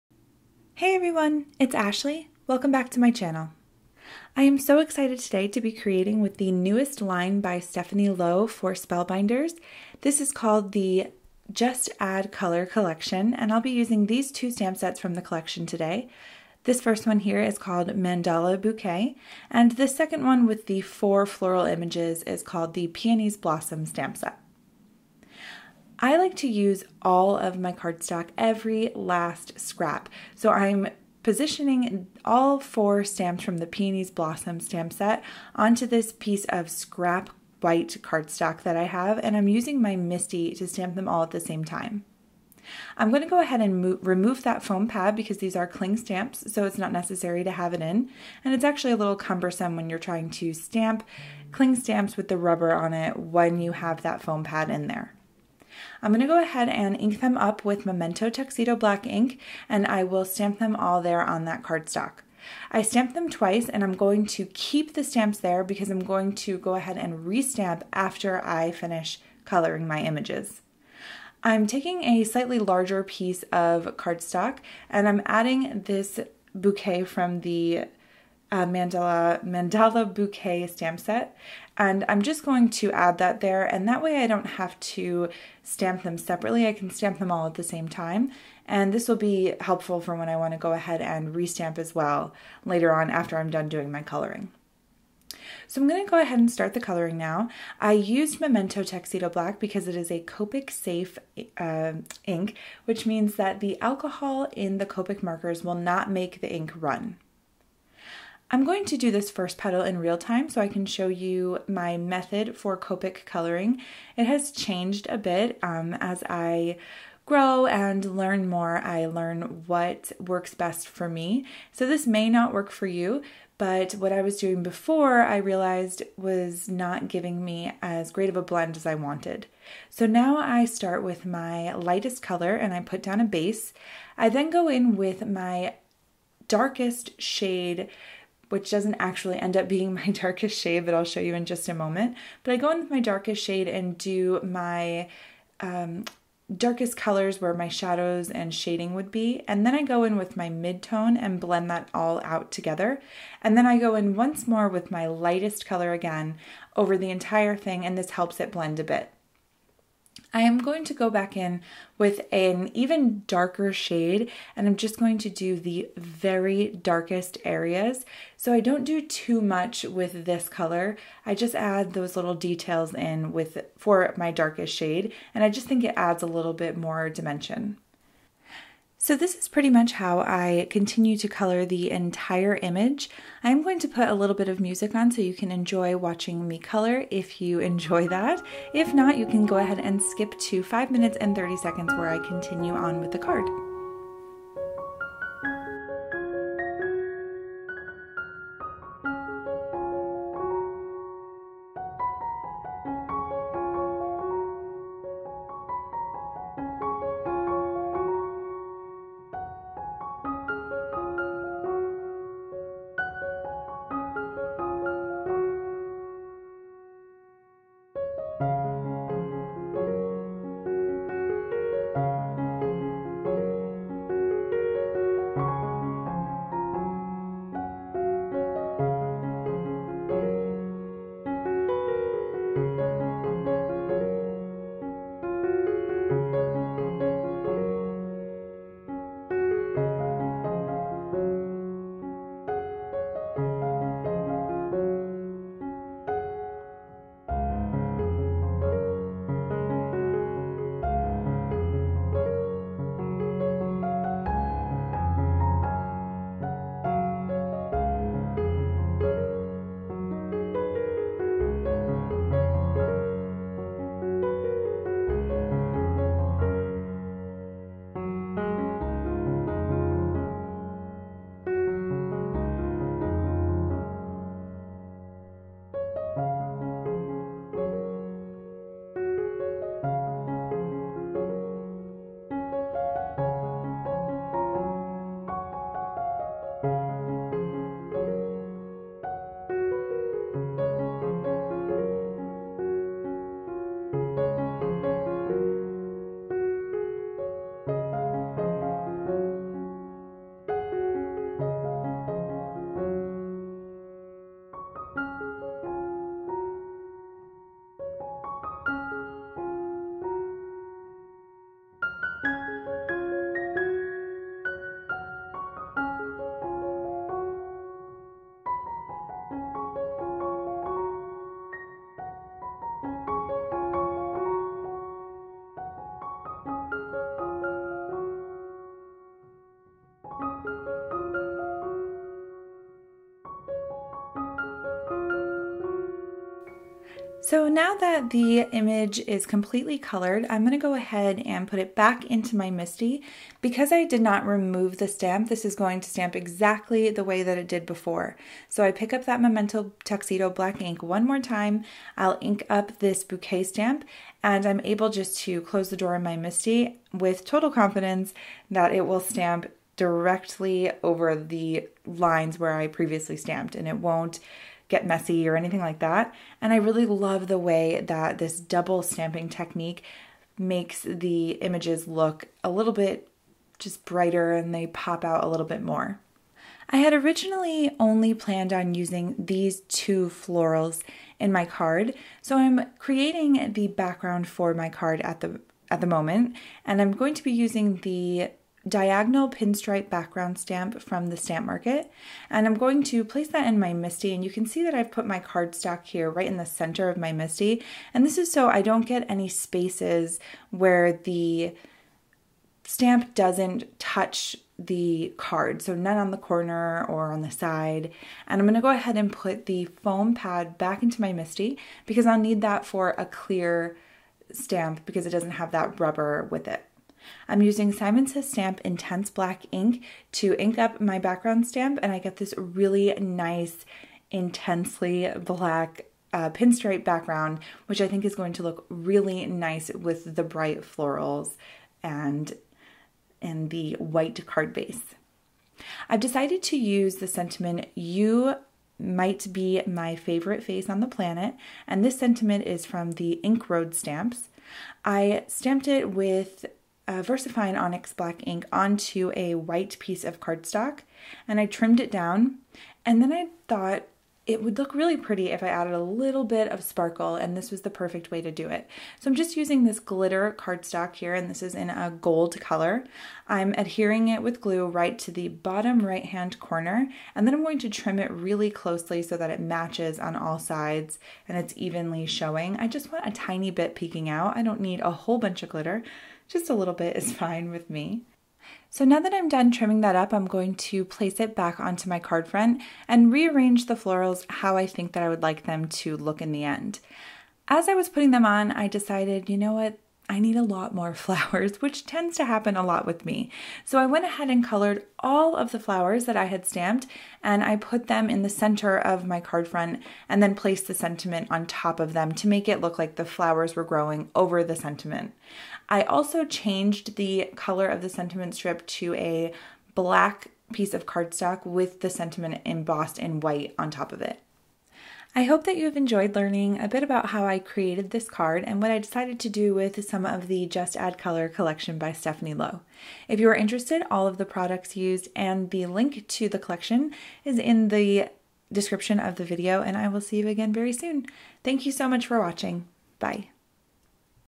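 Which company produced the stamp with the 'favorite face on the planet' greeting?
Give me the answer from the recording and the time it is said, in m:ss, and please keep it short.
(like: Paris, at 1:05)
Ink Road, at 7:23.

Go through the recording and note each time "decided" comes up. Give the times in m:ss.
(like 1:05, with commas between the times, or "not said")
7:15, 8:08, 8:38.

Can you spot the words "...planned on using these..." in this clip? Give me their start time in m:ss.
6:18.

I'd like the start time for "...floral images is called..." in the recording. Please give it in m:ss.
0:21.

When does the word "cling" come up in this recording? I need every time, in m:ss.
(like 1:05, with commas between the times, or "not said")
0:45, 0:51.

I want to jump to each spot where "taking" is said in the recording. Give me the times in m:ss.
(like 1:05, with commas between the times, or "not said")
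1:11.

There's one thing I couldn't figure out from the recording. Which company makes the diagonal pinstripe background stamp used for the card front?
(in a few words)
The Stamp Market.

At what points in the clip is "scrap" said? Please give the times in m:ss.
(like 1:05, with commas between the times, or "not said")
0:29, 0:36.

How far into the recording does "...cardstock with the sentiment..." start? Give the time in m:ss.
8:30.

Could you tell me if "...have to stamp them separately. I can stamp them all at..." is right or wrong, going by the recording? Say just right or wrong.
right.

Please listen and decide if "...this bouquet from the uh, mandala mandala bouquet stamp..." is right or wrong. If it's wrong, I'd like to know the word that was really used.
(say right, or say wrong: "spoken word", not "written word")
right.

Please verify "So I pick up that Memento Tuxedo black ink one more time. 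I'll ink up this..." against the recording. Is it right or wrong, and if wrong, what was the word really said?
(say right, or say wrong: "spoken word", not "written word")
right.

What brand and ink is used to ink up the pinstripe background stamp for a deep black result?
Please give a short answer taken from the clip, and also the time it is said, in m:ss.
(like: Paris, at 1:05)
Simon Says Stamp Intense Black, at 6:57.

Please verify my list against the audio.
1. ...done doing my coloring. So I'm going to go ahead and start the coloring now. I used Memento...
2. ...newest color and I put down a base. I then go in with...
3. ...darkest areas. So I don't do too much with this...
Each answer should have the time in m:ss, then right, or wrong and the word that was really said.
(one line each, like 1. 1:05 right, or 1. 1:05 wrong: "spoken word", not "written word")
1. 1:33 right
2. 2:11 wrong: "lightest", not "newest"
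3. 2:46 right.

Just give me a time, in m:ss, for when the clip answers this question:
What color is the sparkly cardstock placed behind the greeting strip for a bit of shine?
7:42.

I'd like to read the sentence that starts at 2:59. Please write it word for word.
So this is pretty much how I continue to color the entire image.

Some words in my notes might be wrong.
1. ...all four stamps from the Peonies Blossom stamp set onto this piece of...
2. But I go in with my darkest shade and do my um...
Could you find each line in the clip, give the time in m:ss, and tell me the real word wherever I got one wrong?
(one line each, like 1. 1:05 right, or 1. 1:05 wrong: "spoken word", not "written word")
1. 0:32 right
2. 2:22 right.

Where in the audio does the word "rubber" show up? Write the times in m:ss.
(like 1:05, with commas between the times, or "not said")
0:52, 6:55.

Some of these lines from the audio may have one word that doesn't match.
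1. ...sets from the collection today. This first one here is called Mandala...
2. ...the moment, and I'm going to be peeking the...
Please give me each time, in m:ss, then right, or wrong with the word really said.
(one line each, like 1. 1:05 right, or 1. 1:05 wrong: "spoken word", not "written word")
1. 0:14 right
2. 6:25 wrong: "using", not "peeking".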